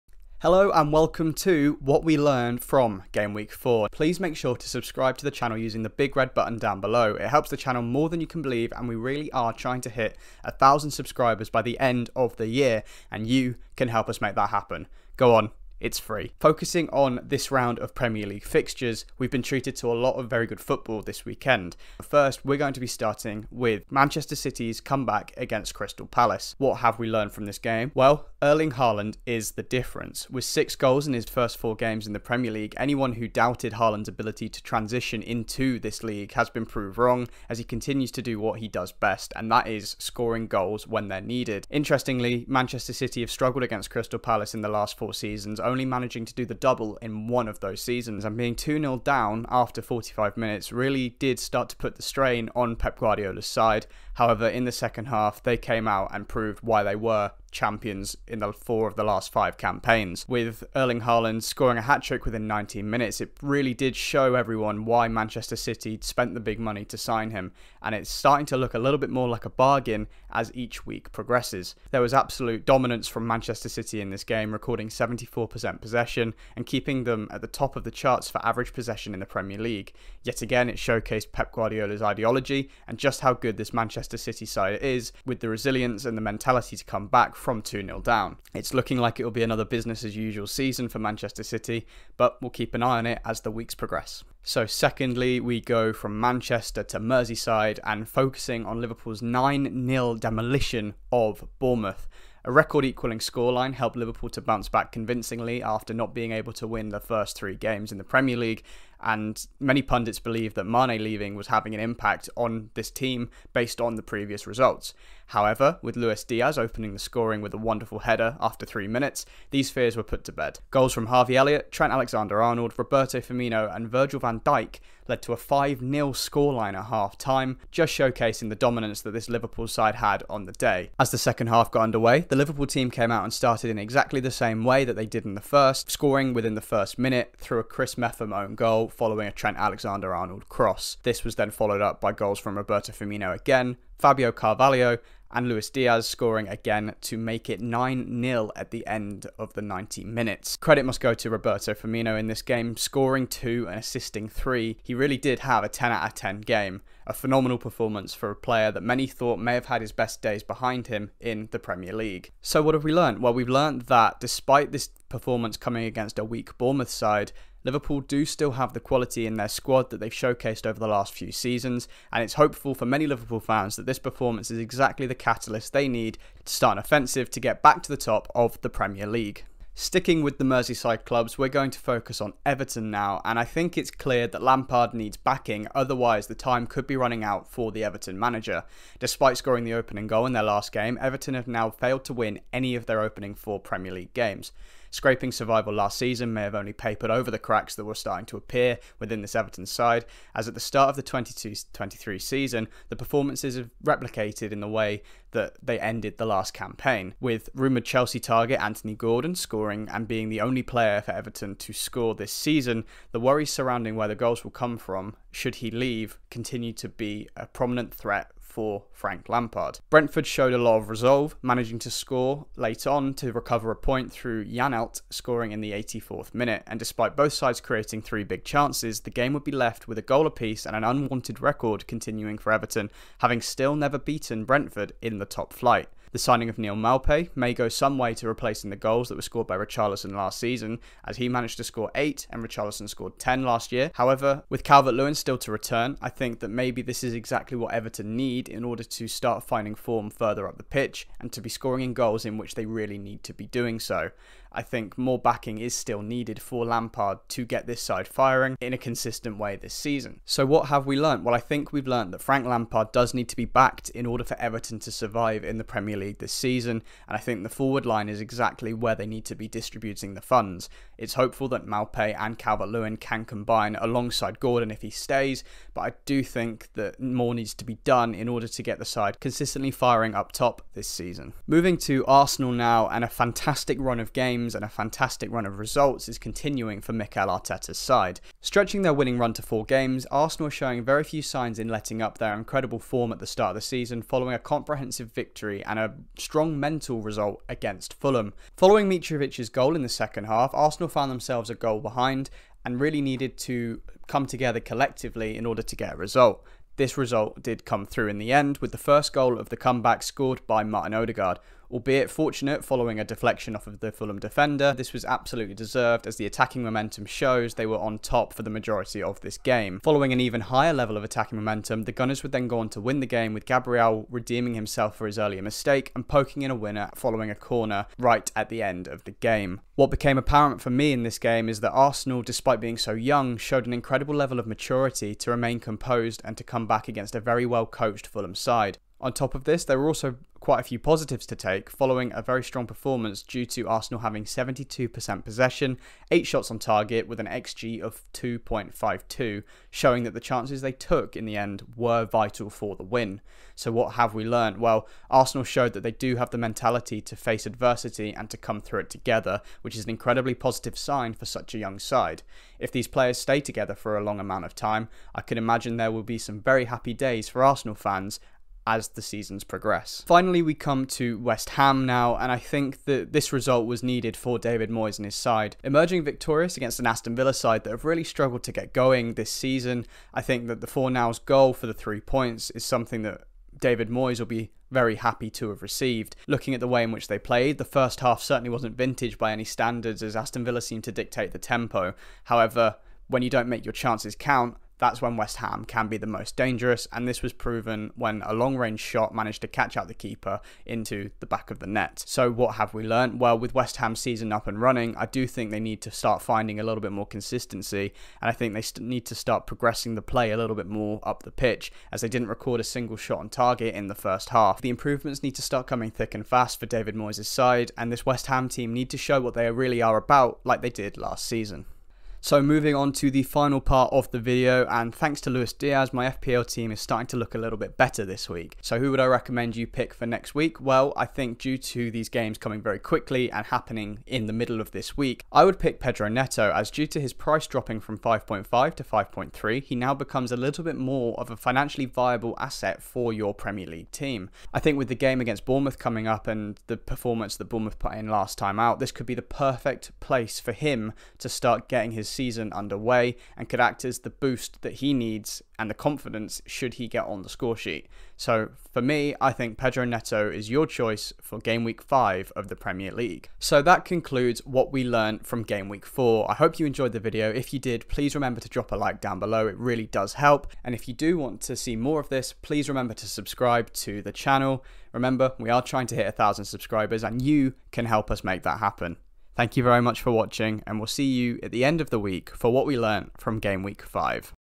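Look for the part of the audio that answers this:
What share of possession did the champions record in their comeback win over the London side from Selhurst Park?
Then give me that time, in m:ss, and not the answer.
1:14.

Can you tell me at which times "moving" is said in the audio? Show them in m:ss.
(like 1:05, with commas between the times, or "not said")
4:41, 7:02.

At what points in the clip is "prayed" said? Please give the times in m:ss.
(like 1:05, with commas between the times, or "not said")
not said.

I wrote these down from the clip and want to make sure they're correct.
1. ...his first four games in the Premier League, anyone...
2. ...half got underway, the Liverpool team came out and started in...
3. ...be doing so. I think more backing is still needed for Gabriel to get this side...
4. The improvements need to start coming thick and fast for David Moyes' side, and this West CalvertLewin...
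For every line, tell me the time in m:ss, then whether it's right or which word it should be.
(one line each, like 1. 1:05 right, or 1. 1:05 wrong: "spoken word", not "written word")
1. 0:31 right
2. 2:11 right
3. 4:13 wrong: "Lampard", not "Gabriel"
4. 6:54 wrong: "Ham", not "CalvertLewin".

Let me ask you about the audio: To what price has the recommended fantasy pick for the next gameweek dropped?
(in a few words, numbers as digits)
5.3.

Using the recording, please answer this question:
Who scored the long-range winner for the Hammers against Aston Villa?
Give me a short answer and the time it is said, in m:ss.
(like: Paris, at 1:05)
Fornals, at 6:20.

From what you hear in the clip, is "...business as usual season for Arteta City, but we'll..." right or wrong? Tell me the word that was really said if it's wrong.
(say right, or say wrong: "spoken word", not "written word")
wrong: "Manchester", not "Arteta".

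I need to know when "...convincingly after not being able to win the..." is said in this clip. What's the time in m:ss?
1:44.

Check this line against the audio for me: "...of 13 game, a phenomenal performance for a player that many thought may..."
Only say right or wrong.
wrong.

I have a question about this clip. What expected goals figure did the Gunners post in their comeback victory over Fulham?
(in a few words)
2.52.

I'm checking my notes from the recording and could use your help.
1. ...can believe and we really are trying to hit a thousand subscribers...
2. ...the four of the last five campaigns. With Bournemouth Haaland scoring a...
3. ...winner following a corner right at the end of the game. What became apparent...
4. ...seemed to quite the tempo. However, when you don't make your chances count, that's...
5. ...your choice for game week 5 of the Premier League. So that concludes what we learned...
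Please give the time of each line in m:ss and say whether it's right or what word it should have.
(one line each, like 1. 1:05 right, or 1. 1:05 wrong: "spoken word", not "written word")
1. 0:08 right
2. 0:58 wrong: "Erling", not "Bournemouth"
3. 5:26 right
4. 6:30 wrong: "dictate", not "quite"
5. 7:40 right.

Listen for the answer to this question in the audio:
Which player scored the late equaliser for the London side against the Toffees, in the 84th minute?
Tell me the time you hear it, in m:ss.
3:44.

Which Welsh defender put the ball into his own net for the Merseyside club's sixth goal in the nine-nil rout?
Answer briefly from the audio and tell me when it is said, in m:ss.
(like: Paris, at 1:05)
Chris Mepham, at 2:17.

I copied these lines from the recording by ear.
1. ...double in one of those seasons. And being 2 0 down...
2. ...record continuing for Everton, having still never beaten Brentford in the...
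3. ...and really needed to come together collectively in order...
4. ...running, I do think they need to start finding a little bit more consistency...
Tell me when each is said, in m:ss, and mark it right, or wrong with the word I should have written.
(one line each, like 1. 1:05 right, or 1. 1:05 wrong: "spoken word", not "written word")
1. 0:46 right
2. 3:51 right
3. 5:02 right
4. 6:44 right.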